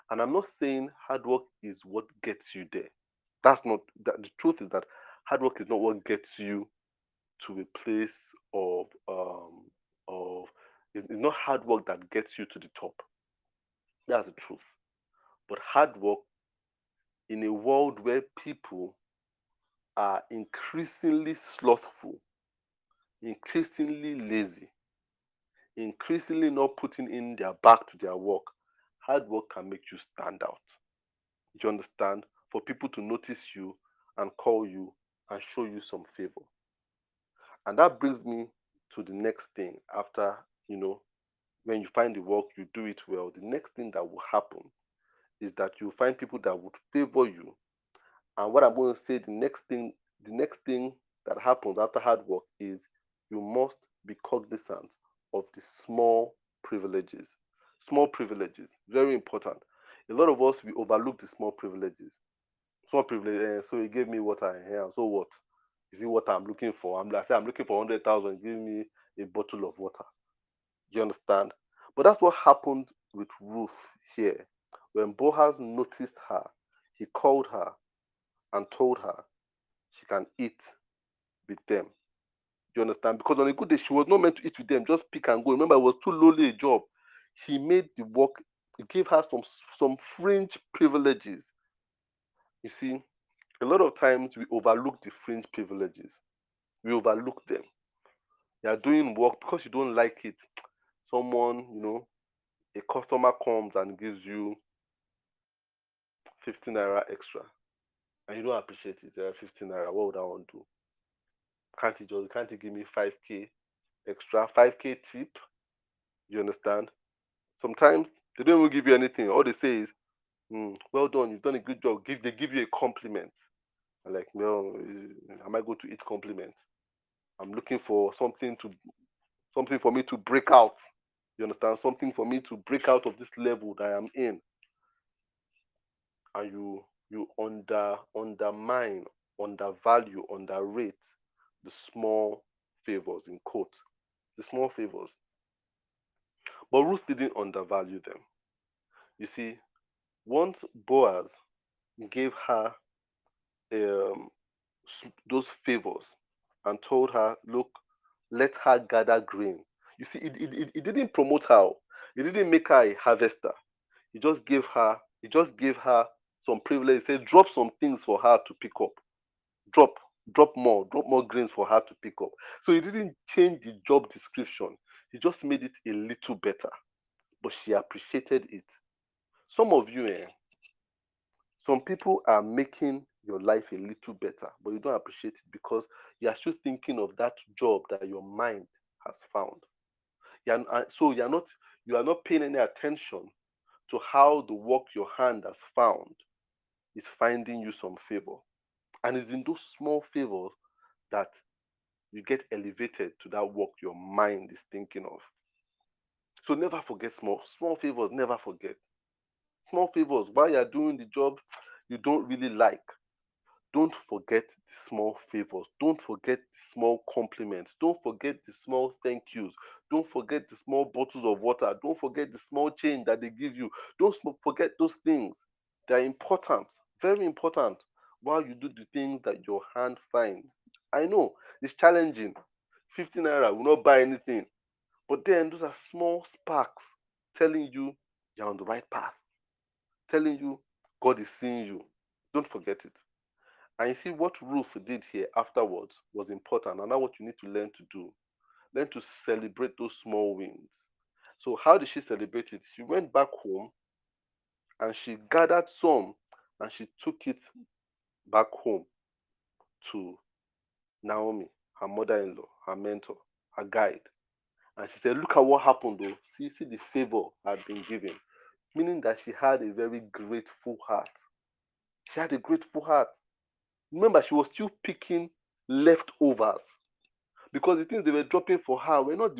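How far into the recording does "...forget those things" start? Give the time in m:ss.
3:44.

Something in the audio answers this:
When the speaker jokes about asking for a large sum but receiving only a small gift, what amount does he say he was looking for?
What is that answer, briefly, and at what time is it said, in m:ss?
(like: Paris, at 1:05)
100,000, at 1:07.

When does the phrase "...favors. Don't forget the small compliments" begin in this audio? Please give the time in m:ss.
3:35.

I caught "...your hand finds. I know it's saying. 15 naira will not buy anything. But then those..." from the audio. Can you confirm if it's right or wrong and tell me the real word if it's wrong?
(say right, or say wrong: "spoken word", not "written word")
wrong: "challenging", not "saying".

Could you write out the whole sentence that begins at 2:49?
Drop, drop more, drop more grains for her to pick up.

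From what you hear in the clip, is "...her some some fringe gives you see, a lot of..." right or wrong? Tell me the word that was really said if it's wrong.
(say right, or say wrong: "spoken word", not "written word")
wrong: "privileges", not "gives".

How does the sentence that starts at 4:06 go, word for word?
And now what you need to learn to do, learn to celebrate those small wins.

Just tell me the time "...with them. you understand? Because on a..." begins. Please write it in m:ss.
1:21.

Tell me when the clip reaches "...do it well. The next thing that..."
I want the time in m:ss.
0:42.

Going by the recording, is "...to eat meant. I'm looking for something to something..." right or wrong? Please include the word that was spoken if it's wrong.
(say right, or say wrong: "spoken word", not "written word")
wrong: "compliment", not "meant".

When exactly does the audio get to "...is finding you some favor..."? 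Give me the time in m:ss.
3:16.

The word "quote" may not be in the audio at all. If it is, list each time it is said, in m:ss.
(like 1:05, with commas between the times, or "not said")
2:23.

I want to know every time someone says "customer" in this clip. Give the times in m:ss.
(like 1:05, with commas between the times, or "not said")
1:42.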